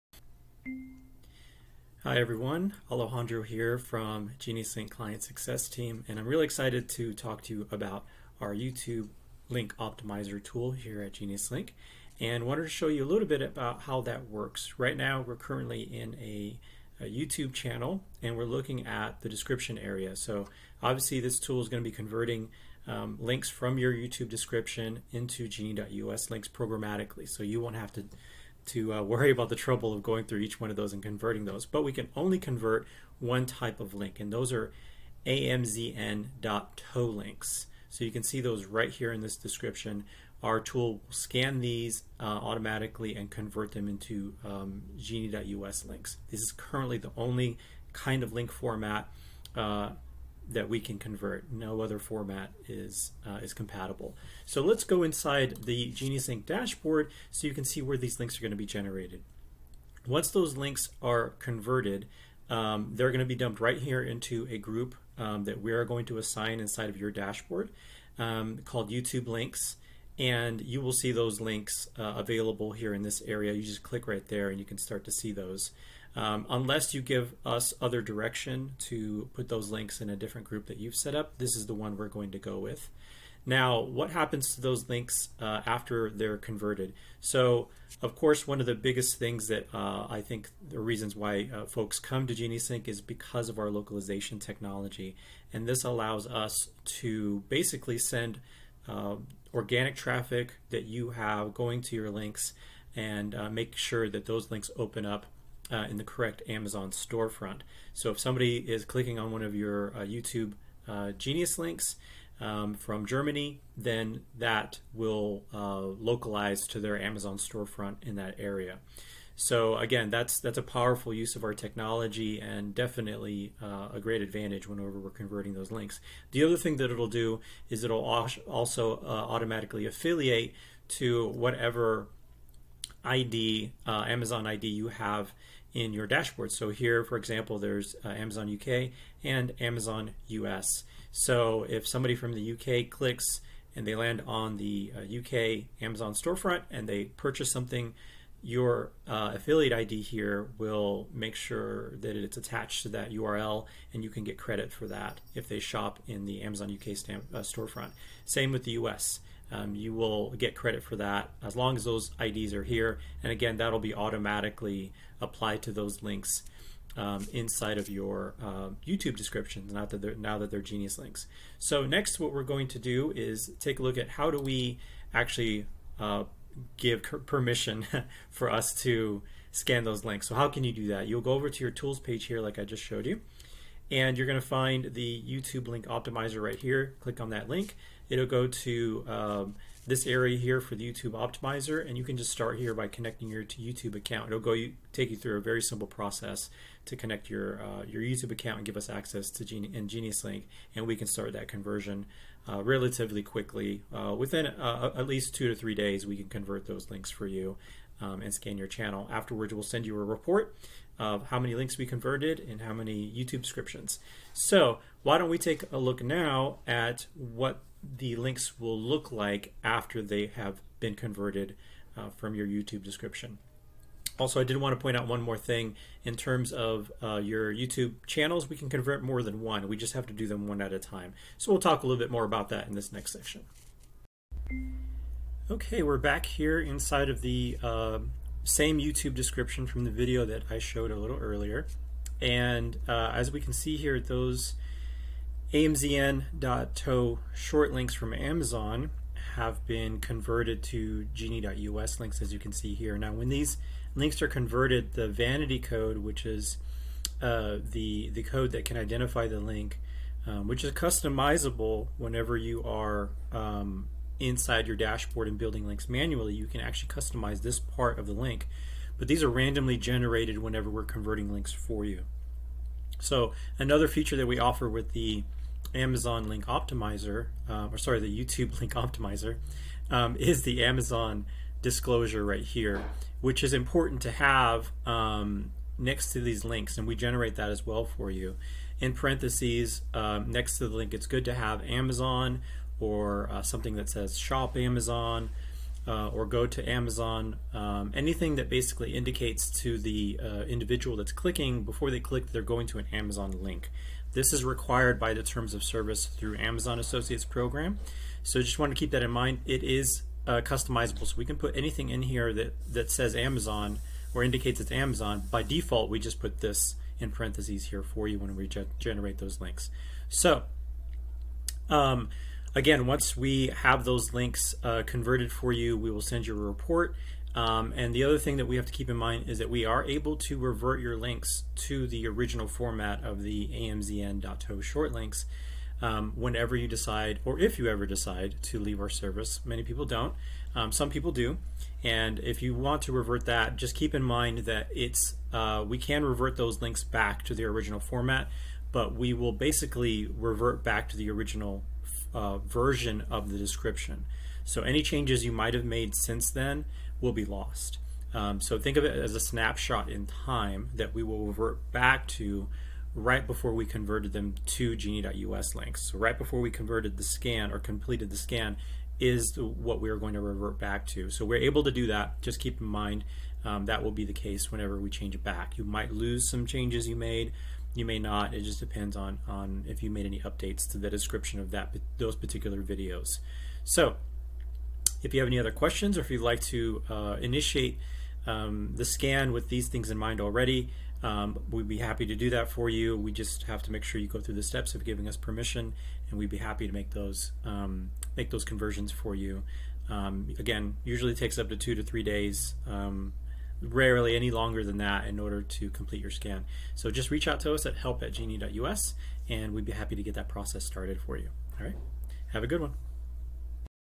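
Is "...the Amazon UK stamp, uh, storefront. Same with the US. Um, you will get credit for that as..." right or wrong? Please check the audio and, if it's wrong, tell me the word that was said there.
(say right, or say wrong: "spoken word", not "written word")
right.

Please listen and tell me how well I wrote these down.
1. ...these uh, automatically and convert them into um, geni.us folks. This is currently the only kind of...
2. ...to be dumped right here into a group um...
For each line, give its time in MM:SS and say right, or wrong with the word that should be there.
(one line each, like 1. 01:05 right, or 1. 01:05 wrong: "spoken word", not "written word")
1. 00:41 wrong: "links", not "folks"
2. 01:03 right.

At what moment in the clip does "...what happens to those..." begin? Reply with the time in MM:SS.
01:23.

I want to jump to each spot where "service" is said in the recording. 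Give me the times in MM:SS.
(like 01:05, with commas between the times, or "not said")
05:05, 05:38.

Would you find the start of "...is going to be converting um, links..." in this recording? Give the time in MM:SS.
00:21.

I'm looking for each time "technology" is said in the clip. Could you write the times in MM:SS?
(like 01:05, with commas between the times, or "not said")
01:34, 02:01.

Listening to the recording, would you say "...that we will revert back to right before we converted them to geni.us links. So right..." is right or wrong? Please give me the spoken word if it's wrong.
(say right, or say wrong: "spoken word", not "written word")
right.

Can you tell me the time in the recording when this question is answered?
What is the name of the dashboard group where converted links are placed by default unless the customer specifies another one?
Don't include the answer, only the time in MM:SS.
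01:08.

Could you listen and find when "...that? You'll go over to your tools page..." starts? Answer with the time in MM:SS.
03:00.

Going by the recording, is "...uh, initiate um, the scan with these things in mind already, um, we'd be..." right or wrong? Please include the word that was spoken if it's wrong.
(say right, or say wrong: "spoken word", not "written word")
right.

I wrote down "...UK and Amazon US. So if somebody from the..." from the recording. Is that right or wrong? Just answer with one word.
right.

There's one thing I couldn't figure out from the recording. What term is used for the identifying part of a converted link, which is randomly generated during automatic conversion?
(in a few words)
vanity code.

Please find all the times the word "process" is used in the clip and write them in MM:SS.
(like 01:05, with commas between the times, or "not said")
03:15, 06:50.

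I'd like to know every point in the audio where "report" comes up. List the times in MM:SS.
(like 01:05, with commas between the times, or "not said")
03:30, 05:26.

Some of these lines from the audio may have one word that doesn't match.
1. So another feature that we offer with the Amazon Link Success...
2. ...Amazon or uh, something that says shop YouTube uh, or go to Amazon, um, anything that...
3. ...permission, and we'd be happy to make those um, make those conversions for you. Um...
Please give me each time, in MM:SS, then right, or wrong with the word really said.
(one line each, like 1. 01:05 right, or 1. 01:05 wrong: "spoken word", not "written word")
1. 04:32 wrong: "Optimizer", not "Success"
2. 04:51 wrong: "Amazon", not "YouTube"
3. 06:35 right.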